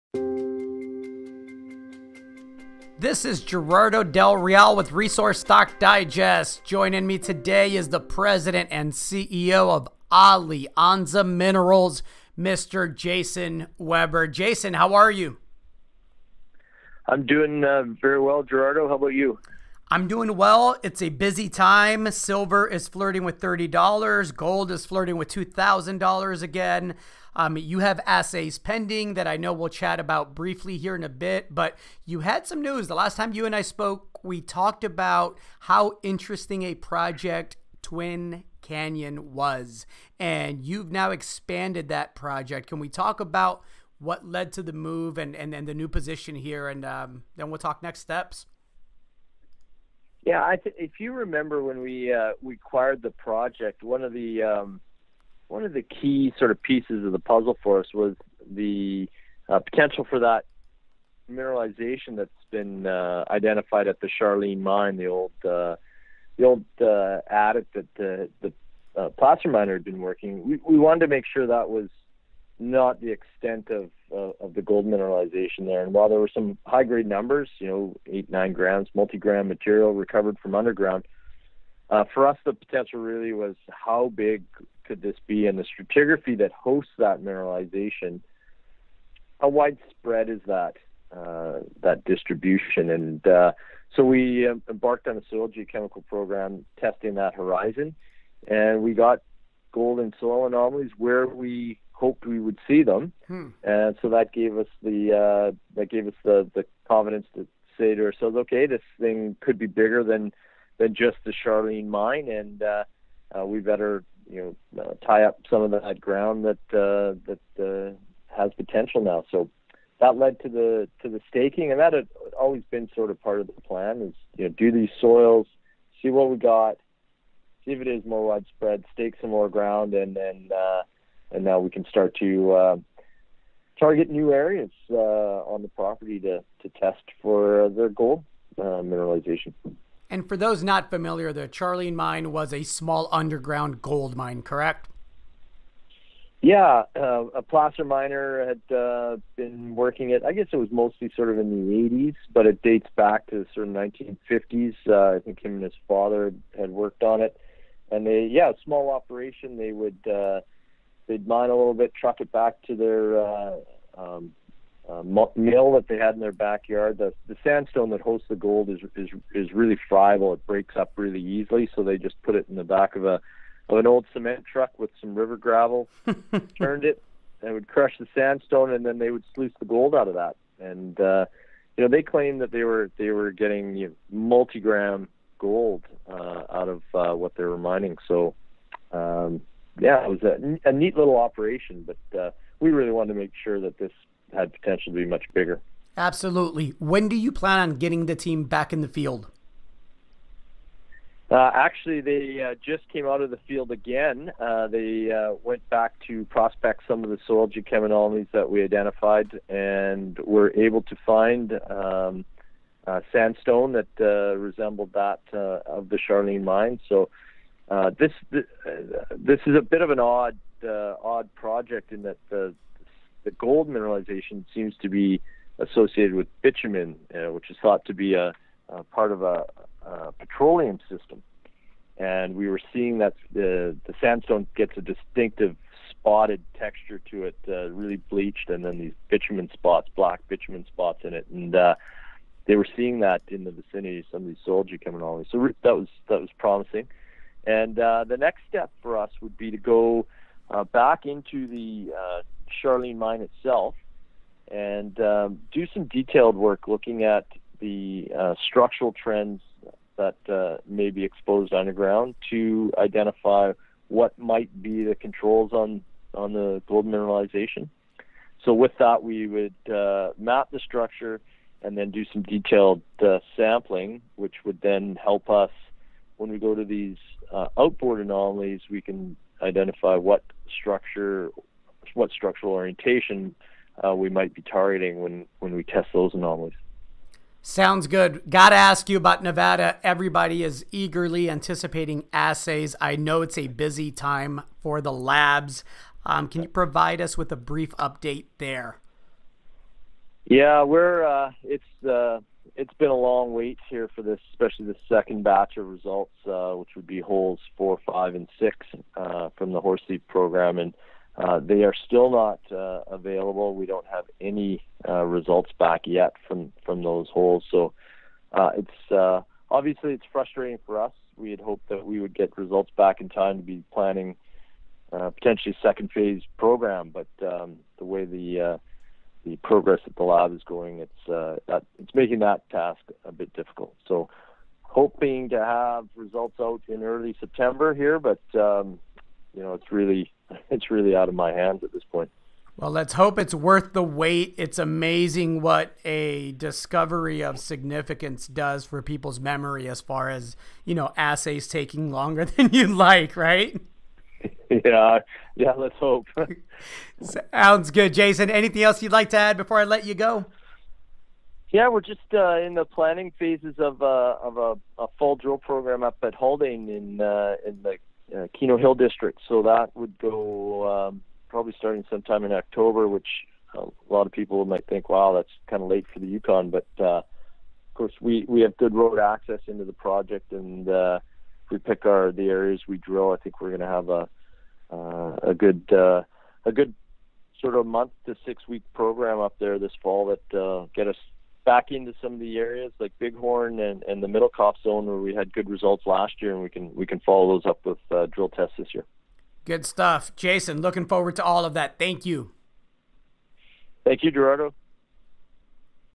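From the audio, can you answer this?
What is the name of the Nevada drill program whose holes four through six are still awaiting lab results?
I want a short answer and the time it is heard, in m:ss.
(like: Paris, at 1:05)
Horsethief, at 5:09.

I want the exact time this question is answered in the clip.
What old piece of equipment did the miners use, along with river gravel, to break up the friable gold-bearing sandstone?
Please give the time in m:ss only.
2:54.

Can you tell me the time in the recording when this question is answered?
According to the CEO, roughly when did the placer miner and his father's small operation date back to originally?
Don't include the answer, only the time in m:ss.
2:33.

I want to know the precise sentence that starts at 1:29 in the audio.
How widespread is that uh, that distribution?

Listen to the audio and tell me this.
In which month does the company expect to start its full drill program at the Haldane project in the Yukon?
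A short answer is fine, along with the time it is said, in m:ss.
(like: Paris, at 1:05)
October, at 6:12.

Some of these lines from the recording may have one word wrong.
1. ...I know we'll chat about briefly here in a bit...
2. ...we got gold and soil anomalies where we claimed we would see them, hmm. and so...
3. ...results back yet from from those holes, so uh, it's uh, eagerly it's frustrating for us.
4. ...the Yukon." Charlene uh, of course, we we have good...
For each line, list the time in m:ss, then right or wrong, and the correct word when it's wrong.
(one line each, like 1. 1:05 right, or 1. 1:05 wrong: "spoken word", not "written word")
1. 0:29 right
2. 1:38 wrong: "hoped", not "claimed"
3. 5:15 wrong: "obviously", not "eagerly"
4. 6:15 wrong: "But", not "Charlene".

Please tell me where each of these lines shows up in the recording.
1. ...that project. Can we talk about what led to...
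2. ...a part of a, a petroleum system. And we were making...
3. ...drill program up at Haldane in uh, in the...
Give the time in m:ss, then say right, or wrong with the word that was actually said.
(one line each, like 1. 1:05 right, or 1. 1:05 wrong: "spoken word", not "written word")
1. 0:41 right
2. 3:48 wrong: "seeing", not "making"
3. 6:05 right.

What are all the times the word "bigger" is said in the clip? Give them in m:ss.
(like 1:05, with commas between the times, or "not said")
1:49, 3:15.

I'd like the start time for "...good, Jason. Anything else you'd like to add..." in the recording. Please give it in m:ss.
5:57.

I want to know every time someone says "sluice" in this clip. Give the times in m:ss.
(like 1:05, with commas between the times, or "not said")
2:59.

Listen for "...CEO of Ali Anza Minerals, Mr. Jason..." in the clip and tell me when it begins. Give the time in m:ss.
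0:08.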